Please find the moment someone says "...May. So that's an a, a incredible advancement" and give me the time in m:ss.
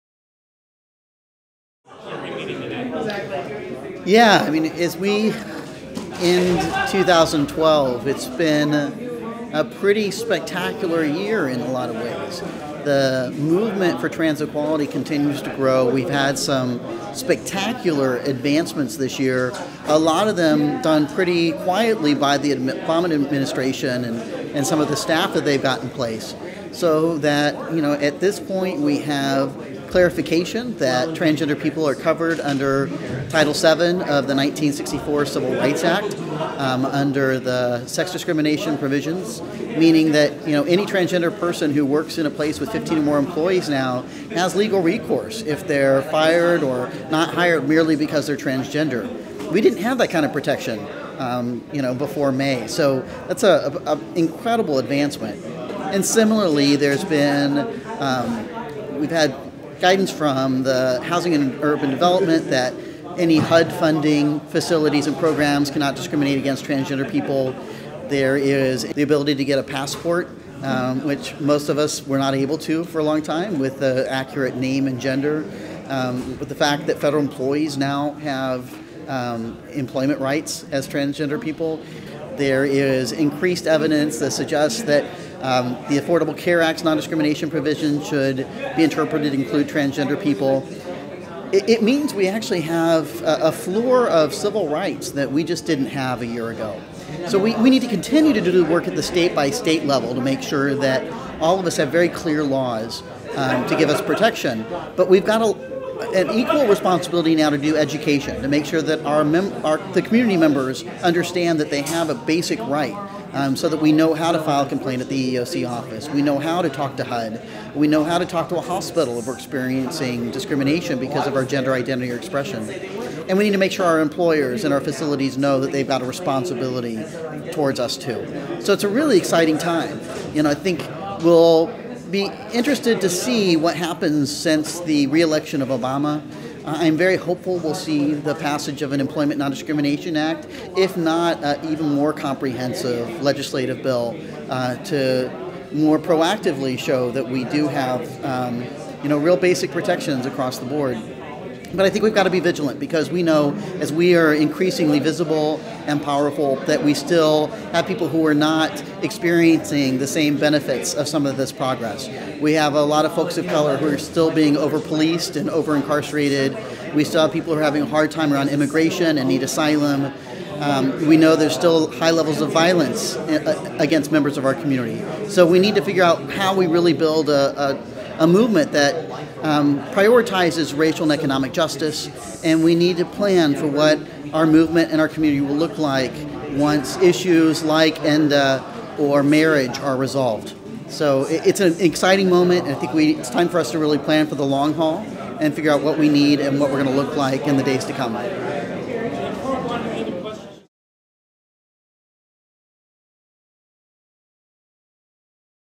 0:52.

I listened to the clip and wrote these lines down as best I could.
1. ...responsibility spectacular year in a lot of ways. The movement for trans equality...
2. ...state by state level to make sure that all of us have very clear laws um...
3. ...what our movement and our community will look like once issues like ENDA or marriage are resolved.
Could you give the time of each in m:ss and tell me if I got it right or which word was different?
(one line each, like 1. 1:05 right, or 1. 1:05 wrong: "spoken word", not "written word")
1. 0:09 wrong: "pretty", not "responsibility"
2. 1:39 right
3. 3:03 right.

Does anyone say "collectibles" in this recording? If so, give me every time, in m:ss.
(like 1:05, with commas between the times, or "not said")
not said.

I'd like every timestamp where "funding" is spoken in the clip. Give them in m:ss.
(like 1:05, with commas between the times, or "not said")
1:03.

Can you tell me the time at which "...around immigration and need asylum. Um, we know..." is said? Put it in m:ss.
2:48.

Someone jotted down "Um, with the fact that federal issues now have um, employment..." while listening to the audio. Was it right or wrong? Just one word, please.
wrong.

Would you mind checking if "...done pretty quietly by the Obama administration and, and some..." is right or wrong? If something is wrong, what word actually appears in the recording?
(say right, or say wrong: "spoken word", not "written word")
right.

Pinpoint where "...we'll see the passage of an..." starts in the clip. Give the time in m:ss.
2:17.